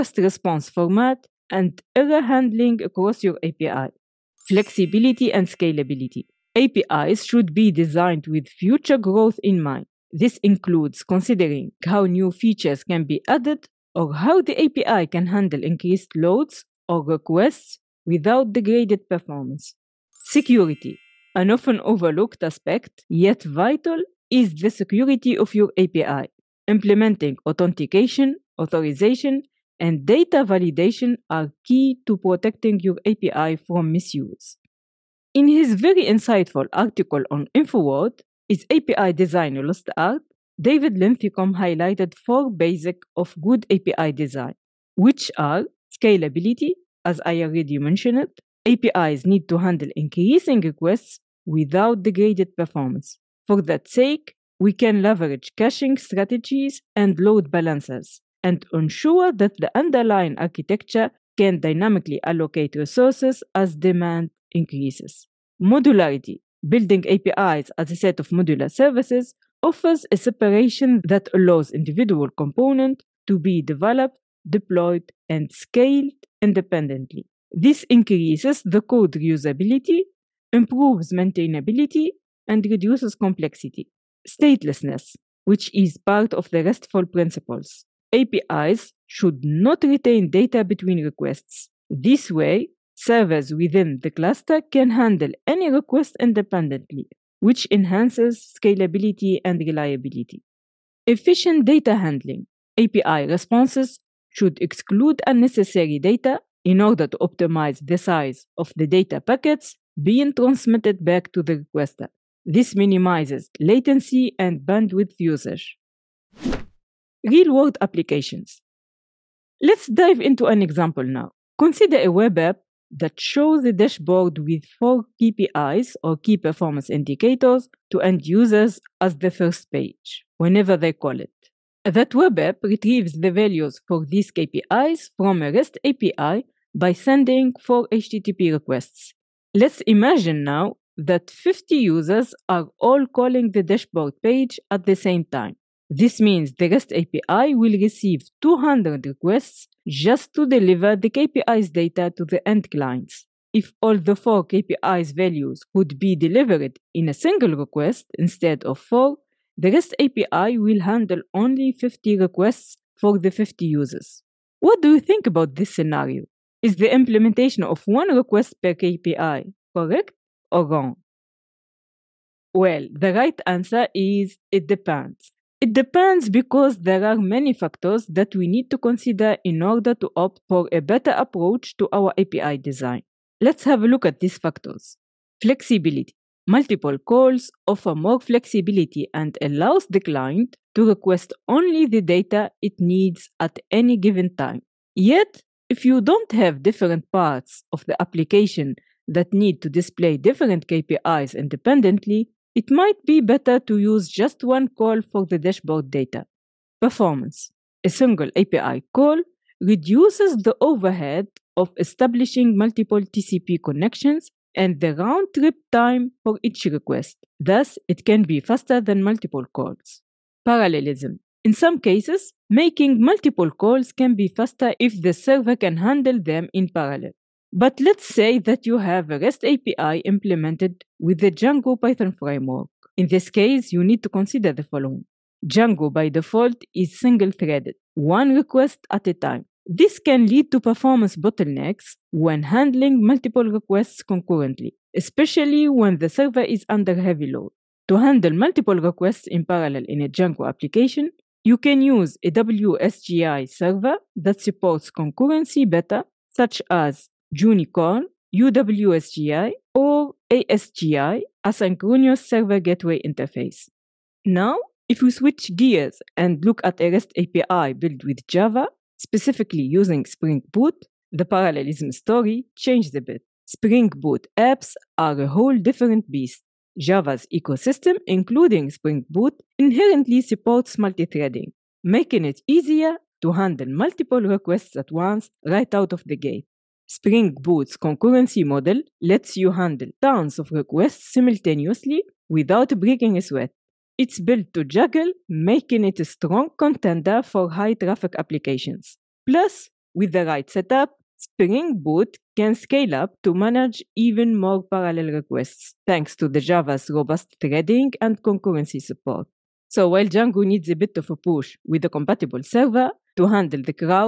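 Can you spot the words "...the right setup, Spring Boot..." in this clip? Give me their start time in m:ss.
5:00.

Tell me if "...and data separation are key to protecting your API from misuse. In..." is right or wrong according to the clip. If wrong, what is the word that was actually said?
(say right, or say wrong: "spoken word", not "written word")
wrong: "validation", not "separation".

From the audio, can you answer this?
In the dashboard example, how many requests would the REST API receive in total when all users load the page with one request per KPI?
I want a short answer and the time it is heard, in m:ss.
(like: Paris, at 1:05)
200, at 2:28.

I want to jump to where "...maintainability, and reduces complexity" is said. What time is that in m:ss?
1:21.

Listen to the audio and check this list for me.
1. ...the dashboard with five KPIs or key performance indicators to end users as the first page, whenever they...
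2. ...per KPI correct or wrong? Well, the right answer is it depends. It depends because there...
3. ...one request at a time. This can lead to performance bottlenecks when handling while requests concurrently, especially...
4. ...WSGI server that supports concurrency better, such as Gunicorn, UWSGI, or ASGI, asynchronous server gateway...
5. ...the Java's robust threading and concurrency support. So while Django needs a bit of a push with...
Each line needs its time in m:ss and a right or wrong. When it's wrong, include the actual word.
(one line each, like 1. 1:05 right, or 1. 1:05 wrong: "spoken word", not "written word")
1. 2:03 wrong: "four", not "five"
2. 2:48 right
3. 3:57 wrong: "multiple", not "while"
4. 4:12 right
5. 5:06 right.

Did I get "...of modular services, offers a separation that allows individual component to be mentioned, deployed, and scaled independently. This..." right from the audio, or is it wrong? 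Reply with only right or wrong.
wrong.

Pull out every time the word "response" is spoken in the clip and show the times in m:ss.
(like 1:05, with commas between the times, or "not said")
0:00, 1:43.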